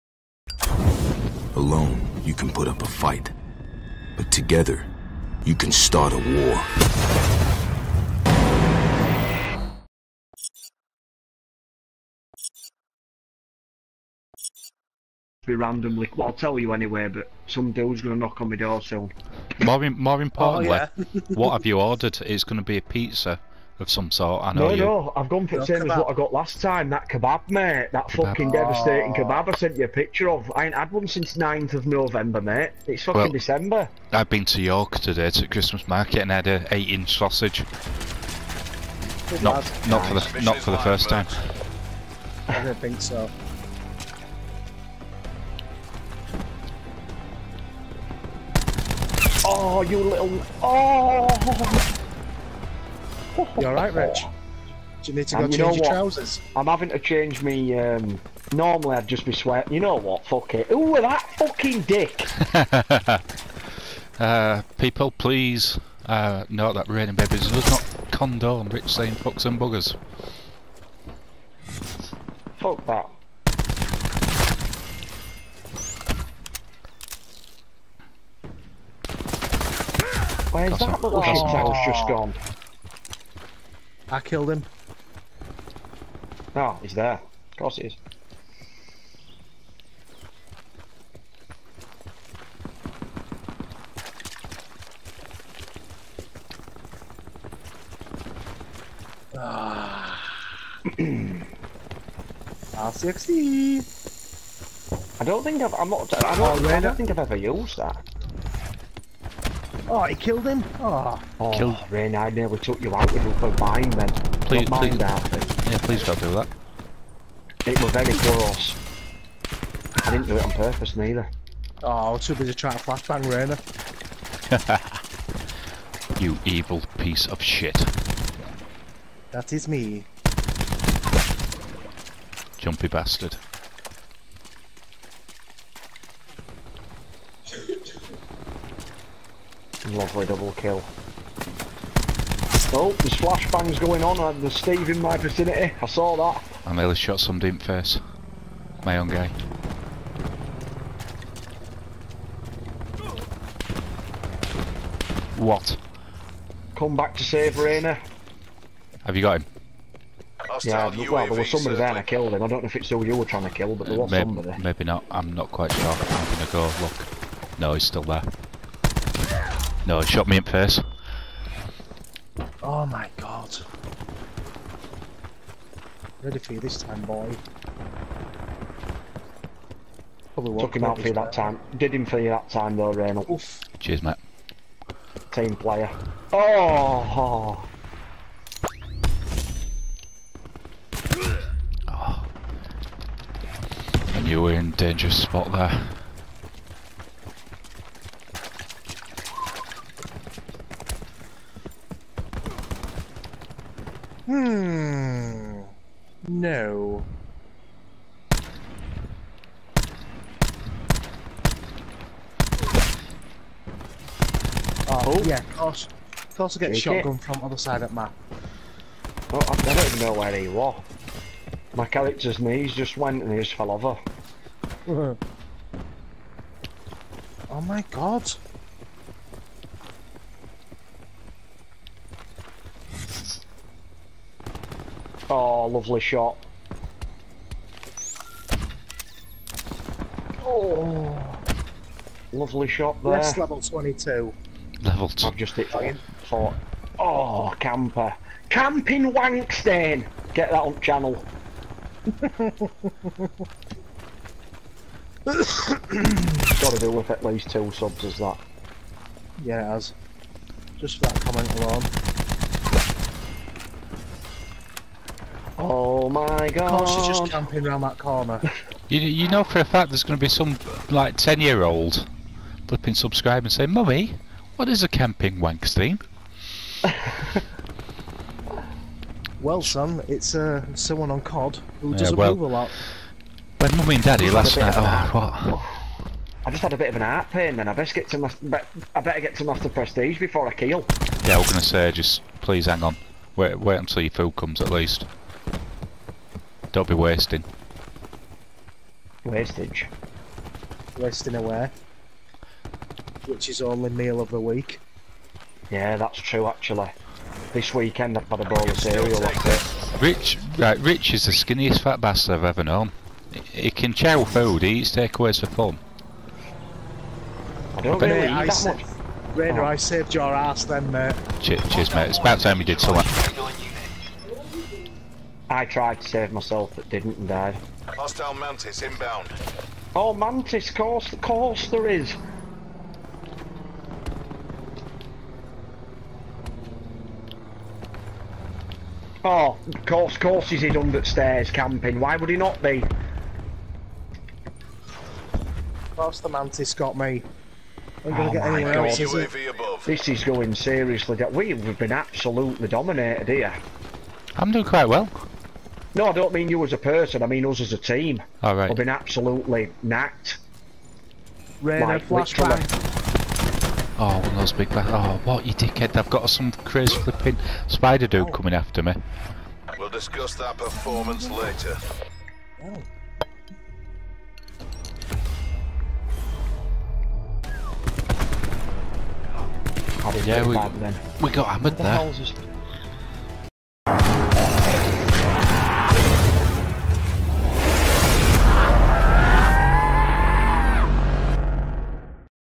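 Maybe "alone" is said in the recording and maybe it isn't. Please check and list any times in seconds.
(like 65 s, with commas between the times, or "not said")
1 s, 261 s.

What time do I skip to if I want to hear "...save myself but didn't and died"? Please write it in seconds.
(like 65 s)
326 s.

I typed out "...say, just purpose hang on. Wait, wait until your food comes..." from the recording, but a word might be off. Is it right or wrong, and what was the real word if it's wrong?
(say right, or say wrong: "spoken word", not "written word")
wrong: "please", not "purpose".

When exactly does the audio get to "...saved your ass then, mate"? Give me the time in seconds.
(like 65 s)
319 s.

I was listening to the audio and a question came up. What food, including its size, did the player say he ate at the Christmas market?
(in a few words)
8-inch sausage.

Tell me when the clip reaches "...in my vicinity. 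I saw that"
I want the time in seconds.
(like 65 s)
144 s.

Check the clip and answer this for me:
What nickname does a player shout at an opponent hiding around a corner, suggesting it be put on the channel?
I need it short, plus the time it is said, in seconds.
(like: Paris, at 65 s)
Camping Wankstein, at 248 s.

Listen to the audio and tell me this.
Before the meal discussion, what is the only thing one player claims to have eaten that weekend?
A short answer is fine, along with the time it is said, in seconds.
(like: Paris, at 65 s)
A bowl of cereal, at 308 s.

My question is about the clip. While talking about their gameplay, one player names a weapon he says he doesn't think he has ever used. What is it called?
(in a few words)
R60.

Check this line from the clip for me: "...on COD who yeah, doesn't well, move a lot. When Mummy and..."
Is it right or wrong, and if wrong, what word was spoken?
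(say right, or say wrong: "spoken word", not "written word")
right.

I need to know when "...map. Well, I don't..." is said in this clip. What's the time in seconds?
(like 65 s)
217 s.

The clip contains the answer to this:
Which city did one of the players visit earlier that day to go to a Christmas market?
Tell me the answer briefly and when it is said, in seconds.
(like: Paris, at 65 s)
York, at 34 s.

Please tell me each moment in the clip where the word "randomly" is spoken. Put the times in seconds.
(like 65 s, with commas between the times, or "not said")
15 s.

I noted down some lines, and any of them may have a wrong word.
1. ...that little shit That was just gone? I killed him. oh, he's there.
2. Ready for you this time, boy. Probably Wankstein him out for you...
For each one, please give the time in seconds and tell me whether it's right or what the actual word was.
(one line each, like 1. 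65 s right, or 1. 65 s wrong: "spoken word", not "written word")
1. 80 s right
2. 176 s wrong: "Took", not "Wankstein".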